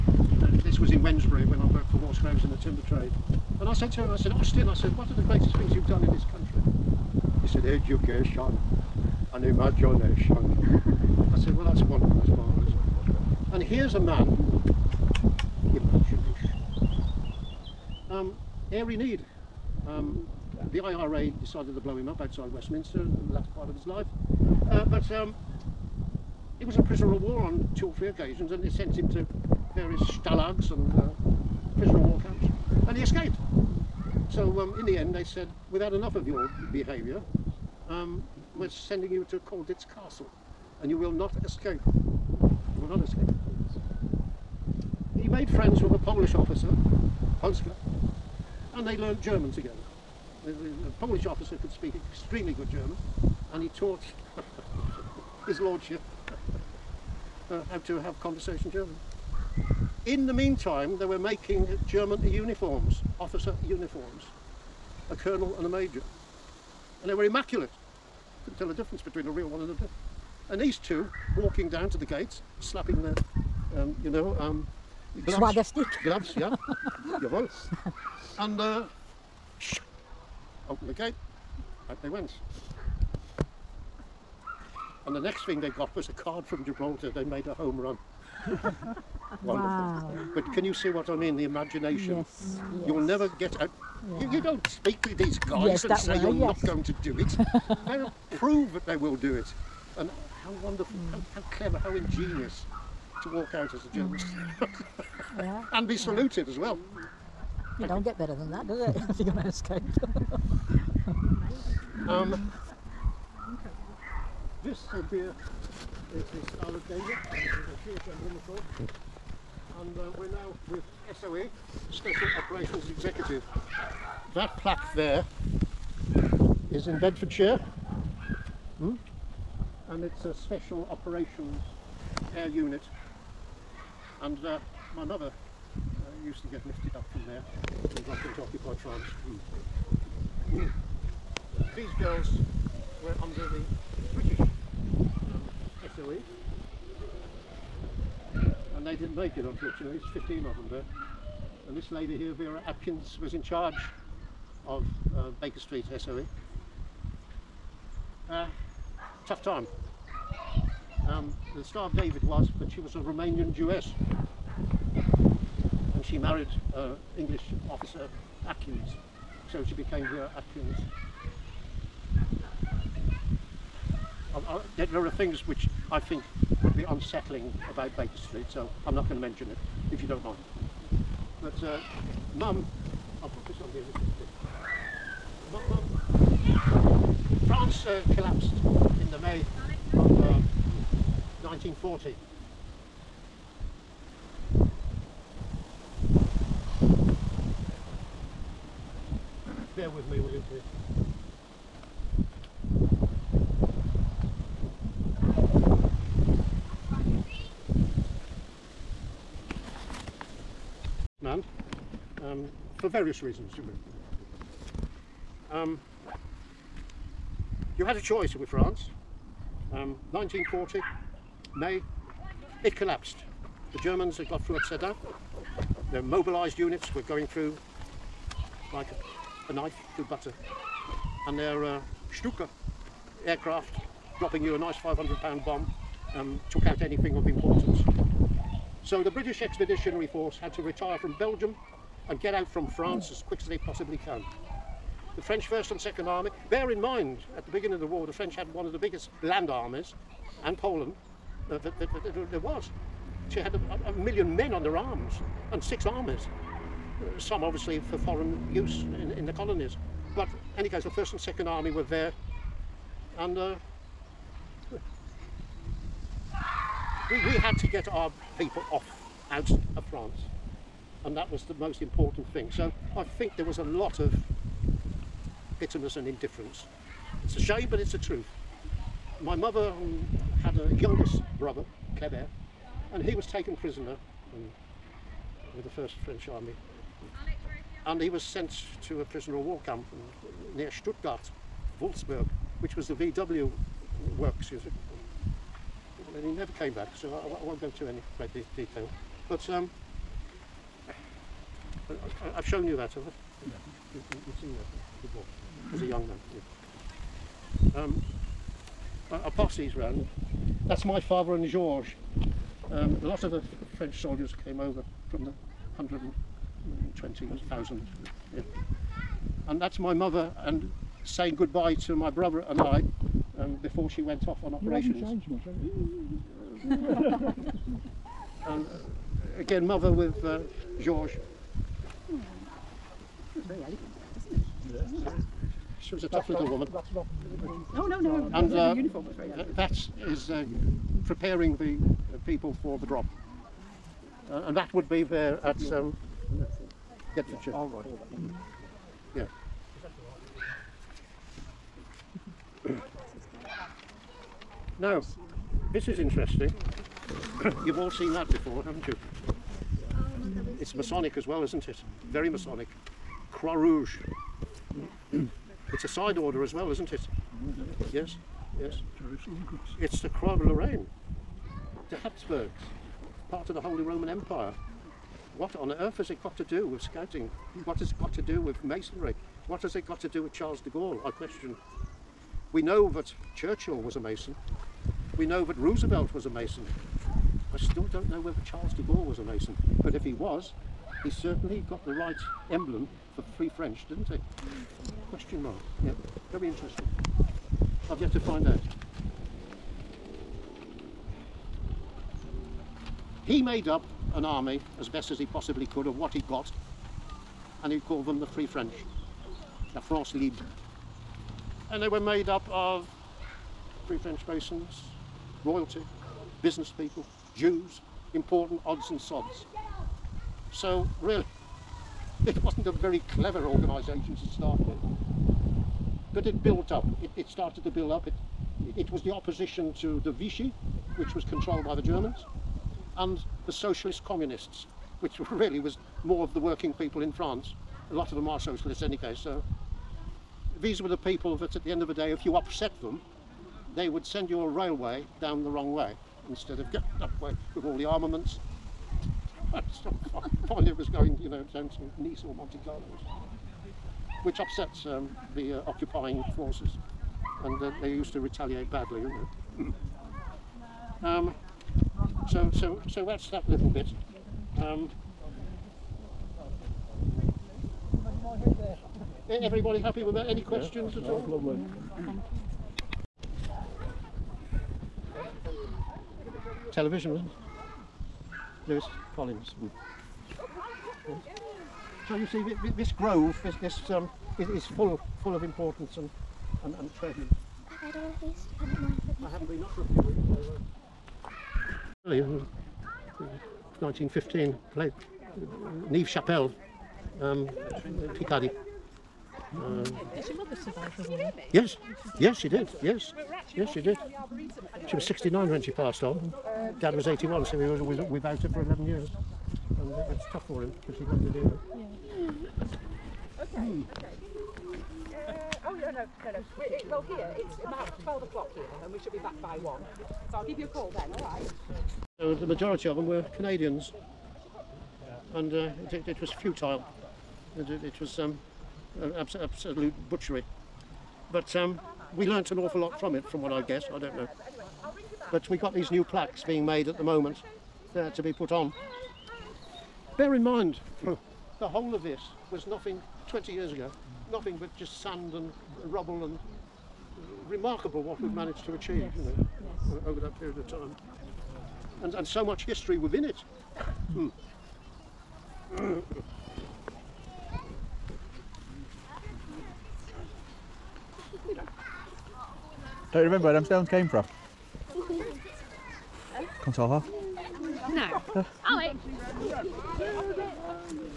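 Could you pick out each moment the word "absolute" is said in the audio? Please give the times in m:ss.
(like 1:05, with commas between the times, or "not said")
8:49.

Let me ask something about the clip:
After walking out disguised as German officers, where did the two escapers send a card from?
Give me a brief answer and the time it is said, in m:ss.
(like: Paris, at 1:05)
Gibraltar, at 1:26.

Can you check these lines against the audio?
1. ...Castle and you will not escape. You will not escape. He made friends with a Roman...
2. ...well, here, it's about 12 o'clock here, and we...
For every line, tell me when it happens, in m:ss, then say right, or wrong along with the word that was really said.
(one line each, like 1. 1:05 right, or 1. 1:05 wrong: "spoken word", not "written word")
1. 0:39 wrong: "Polish", not "Roman"
2. 8:36 right.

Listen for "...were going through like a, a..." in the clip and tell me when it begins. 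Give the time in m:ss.
3:46.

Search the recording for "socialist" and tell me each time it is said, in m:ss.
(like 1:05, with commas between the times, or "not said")
7:13, 7:18.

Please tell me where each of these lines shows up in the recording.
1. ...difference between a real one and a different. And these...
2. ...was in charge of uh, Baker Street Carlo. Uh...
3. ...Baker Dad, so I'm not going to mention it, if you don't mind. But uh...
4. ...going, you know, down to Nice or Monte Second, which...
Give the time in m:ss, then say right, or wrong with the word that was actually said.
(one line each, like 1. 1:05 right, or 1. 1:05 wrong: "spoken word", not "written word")
1. 1:08 right
2. 2:33 wrong: "SOE", not "Carlo"
3. 2:57 wrong: "Street", not "Dad"
4. 7:30 wrong: "Carlo", not "Second".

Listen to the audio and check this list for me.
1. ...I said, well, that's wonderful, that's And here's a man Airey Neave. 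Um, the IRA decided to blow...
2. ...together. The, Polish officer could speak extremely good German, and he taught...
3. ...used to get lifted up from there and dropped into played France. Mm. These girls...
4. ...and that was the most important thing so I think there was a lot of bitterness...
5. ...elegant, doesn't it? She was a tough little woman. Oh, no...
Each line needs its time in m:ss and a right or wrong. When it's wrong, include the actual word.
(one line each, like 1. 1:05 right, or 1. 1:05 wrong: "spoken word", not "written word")
1. 0:11 right
2. 0:49 right
3. 2:16 wrong: "occupied", not "played"
4. 4:31 right
5. 5:33 right.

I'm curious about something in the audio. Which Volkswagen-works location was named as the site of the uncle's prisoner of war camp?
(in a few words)
Wolfsburg.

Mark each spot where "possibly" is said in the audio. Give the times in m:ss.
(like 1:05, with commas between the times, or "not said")
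4:03, 6:45.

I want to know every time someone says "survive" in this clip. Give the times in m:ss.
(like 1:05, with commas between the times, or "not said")
8:20.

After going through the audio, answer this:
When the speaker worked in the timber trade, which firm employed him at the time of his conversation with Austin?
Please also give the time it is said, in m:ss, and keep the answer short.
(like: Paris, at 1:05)
Watergrounds, at 0:01.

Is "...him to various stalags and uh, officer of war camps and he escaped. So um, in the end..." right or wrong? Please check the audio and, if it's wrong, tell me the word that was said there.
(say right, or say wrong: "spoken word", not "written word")
wrong: "prisoner", not "officer".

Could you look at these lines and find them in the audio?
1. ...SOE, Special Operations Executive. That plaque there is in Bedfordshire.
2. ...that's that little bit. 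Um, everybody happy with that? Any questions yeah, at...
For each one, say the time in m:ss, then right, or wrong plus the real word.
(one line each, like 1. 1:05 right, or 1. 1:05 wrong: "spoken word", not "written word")
1. 2:01 right
2. 7:43 right.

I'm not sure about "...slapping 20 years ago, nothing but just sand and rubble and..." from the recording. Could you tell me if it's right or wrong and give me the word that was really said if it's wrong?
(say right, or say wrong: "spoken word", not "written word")
wrong: "nothing", not "slapping".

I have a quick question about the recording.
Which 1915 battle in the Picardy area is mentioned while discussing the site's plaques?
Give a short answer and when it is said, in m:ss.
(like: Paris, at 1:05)
Neuve Chapelle, at 8:15.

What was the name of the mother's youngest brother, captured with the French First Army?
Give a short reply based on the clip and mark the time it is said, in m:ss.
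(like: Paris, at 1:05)
Kleber, at 4:41.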